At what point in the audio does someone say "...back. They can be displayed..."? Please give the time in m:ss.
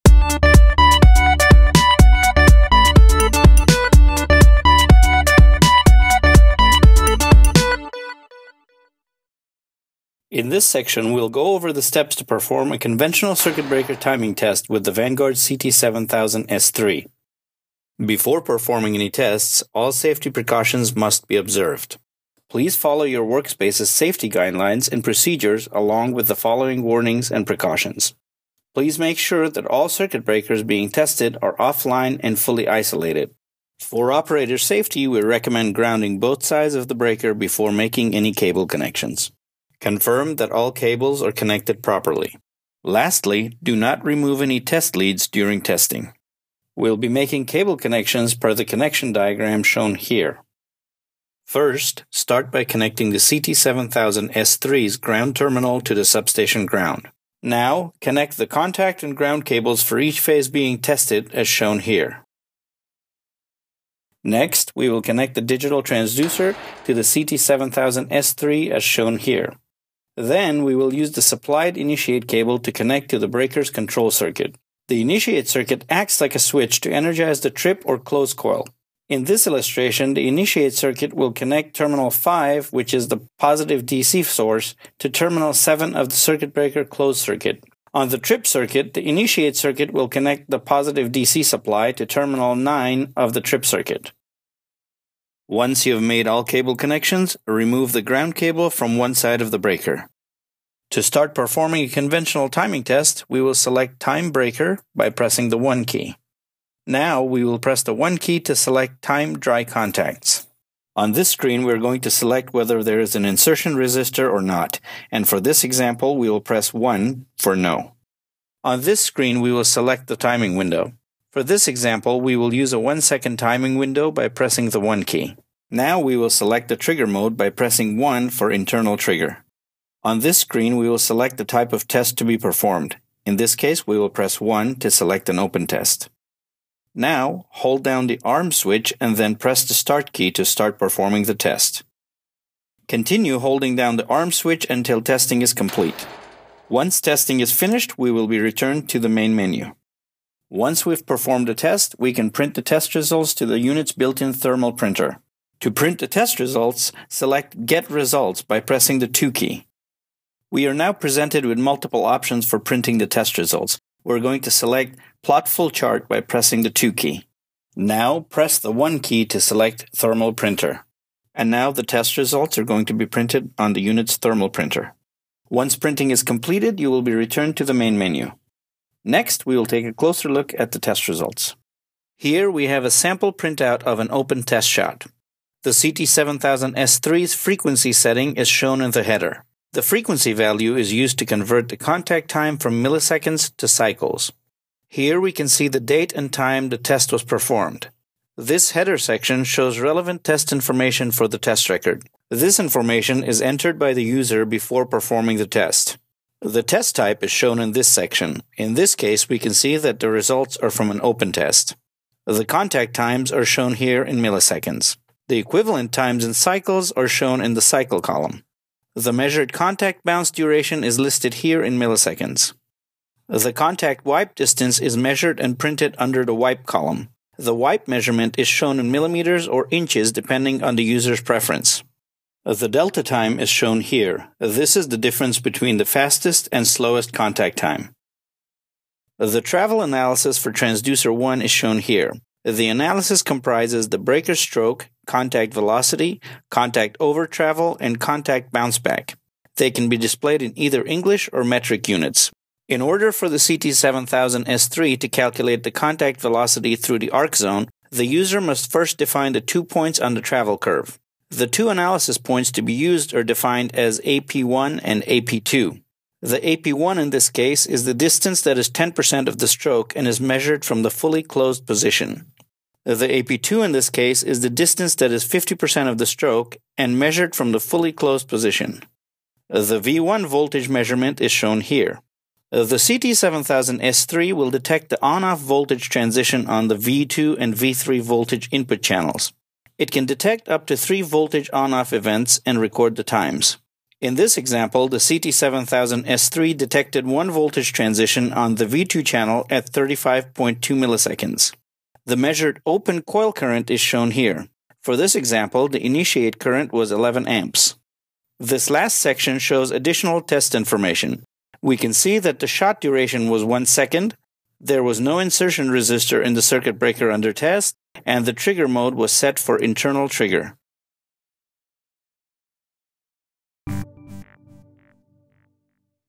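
4:08.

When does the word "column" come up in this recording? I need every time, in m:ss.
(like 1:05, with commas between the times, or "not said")
3:38, 3:46.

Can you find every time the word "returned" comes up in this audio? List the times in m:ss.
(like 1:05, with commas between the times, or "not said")
2:28, 2:57.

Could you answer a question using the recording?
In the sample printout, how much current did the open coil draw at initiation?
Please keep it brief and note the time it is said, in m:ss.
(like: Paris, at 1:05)
11 amps, at 5:06.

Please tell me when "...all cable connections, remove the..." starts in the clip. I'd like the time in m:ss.
1:36.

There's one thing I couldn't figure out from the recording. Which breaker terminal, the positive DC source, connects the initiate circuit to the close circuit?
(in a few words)
5.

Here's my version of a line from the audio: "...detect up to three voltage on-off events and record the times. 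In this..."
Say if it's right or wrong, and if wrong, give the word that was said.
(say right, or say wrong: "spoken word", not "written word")
right.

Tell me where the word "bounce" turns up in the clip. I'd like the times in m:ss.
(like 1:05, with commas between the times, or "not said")
3:40, 4:08.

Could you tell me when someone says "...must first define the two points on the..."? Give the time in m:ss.
4:18.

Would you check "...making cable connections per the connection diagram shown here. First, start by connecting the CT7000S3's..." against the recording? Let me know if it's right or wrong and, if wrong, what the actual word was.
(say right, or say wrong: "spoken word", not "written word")
right.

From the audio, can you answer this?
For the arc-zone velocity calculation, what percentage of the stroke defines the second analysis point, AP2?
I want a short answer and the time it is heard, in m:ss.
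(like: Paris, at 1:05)
50%, at 4:35.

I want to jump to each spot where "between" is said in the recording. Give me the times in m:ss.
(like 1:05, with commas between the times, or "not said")
3:55.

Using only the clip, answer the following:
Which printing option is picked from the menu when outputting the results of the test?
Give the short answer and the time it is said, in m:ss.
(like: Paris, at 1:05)
Plot Full Chart, at 2:45.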